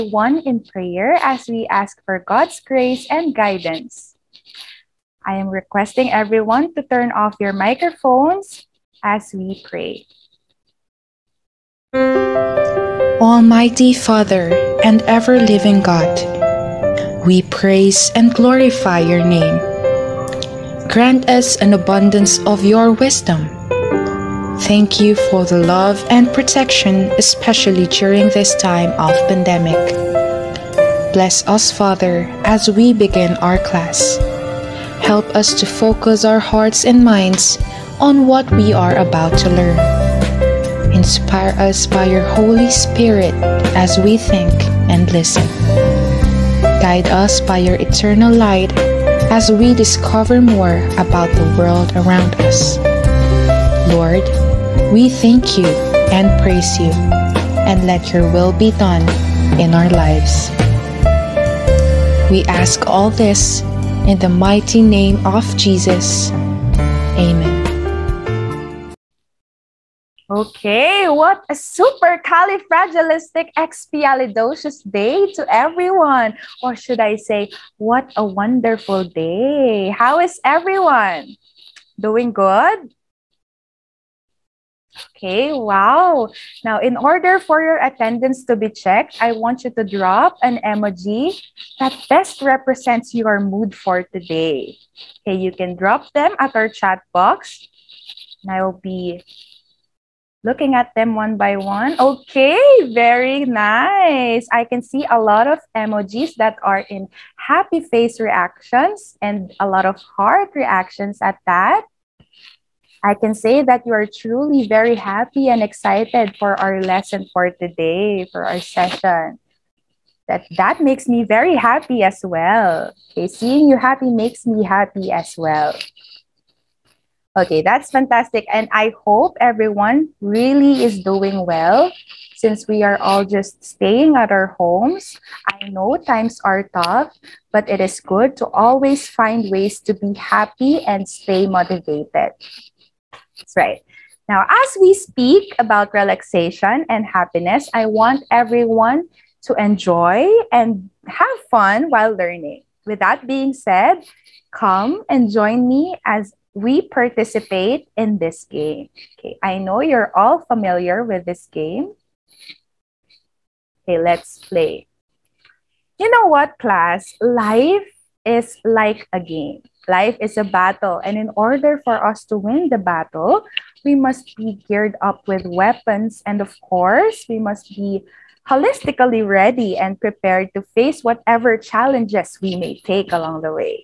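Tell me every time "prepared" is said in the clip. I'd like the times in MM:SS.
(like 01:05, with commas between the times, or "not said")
03:00.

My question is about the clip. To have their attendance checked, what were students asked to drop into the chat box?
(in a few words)
an emoji.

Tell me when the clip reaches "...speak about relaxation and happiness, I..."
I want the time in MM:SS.
02:24.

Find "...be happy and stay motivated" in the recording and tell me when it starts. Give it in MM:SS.
02:19.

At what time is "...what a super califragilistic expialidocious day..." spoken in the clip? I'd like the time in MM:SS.
01:11.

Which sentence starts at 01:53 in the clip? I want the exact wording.
I can say that you are truly very happy and excited for our lesson for today, for our session.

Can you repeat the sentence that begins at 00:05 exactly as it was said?
I am requesting everyone to turn off your microphones as we pray.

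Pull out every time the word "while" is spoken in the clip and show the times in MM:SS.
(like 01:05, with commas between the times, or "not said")
02:31.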